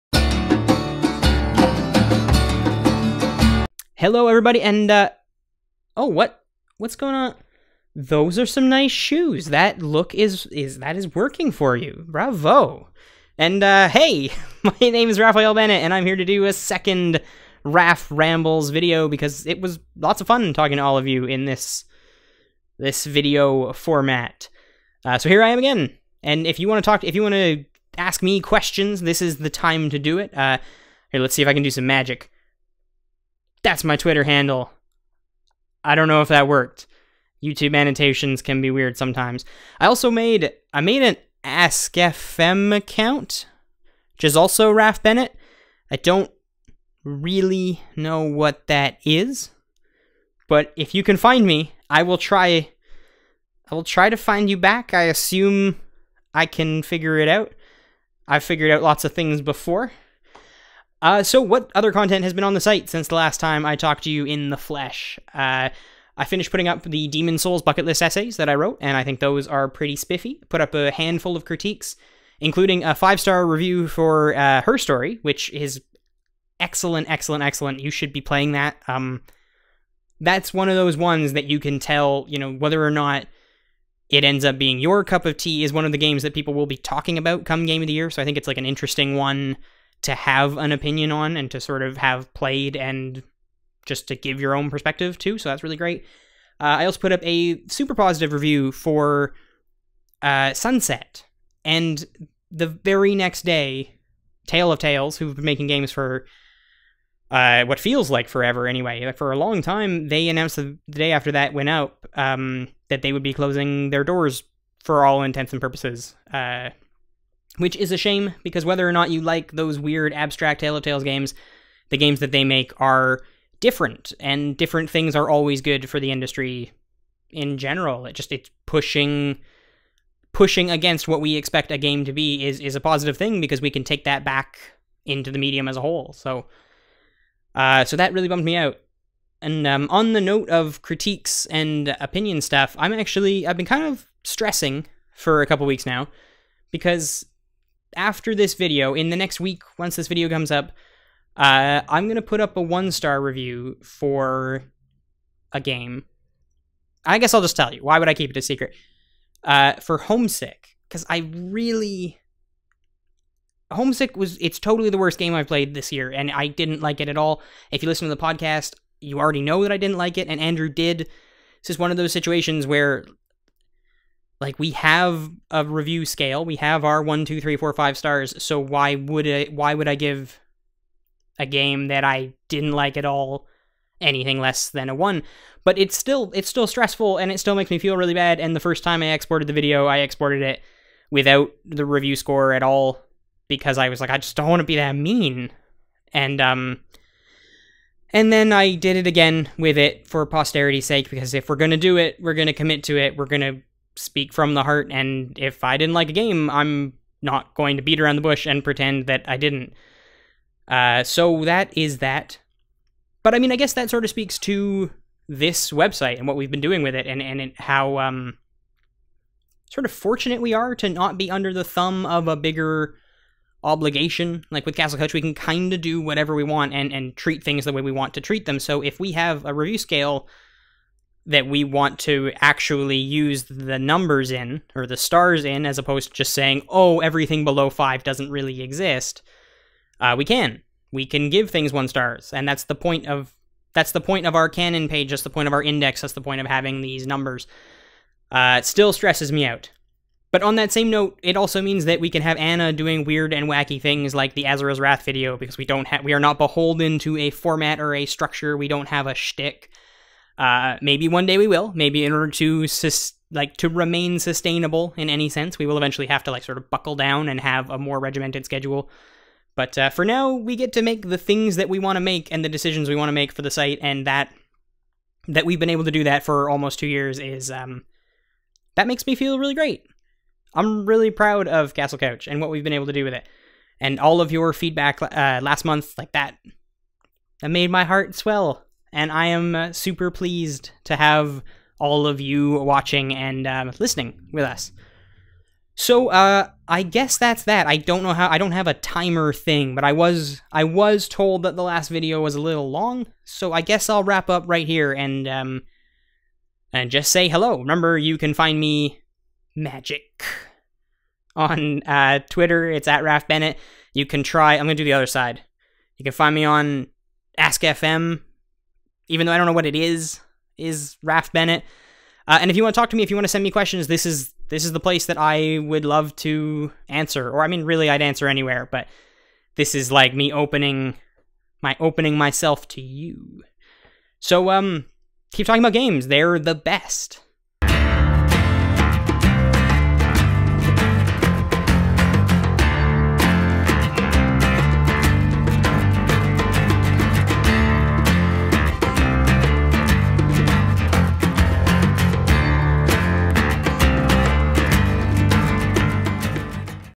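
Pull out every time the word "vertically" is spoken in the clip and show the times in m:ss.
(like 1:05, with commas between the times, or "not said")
not said.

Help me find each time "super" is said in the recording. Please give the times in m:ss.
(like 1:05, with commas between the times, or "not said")
1:37, 4:49.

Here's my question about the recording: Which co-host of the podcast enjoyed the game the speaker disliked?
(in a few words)
Andrew.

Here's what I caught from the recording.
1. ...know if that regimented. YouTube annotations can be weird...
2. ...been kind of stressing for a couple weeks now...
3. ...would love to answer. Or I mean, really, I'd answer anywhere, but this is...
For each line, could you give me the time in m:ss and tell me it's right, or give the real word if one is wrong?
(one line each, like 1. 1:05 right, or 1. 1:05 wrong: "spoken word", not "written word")
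1. 0:36 wrong: "worked", not "regimented"
2. 2:23 right
3. 5:25 right.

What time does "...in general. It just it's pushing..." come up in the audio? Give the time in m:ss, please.
2:07.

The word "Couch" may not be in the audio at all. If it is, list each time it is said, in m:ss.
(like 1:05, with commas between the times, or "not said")
3:44, 4:41.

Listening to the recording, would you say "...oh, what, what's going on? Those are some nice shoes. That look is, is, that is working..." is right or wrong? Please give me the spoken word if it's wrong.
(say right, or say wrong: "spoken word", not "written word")
right.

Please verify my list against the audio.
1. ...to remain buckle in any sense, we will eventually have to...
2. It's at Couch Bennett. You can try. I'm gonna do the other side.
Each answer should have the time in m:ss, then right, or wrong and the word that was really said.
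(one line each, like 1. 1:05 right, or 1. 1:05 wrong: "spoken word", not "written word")
1. 4:23 wrong: "sustainable", not "buckle"
2. 5:12 wrong: "Raph", not "Couch".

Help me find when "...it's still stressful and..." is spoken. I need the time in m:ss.
3:06.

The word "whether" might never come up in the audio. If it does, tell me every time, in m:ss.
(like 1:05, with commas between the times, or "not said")
1:22, 1:58.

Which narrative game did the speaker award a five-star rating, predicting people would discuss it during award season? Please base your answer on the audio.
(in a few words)
Her Story.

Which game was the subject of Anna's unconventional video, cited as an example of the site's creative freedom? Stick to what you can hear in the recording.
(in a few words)
Asura's Wrath.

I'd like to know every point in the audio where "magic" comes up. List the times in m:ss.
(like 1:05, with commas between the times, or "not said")
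0:31, 5:09.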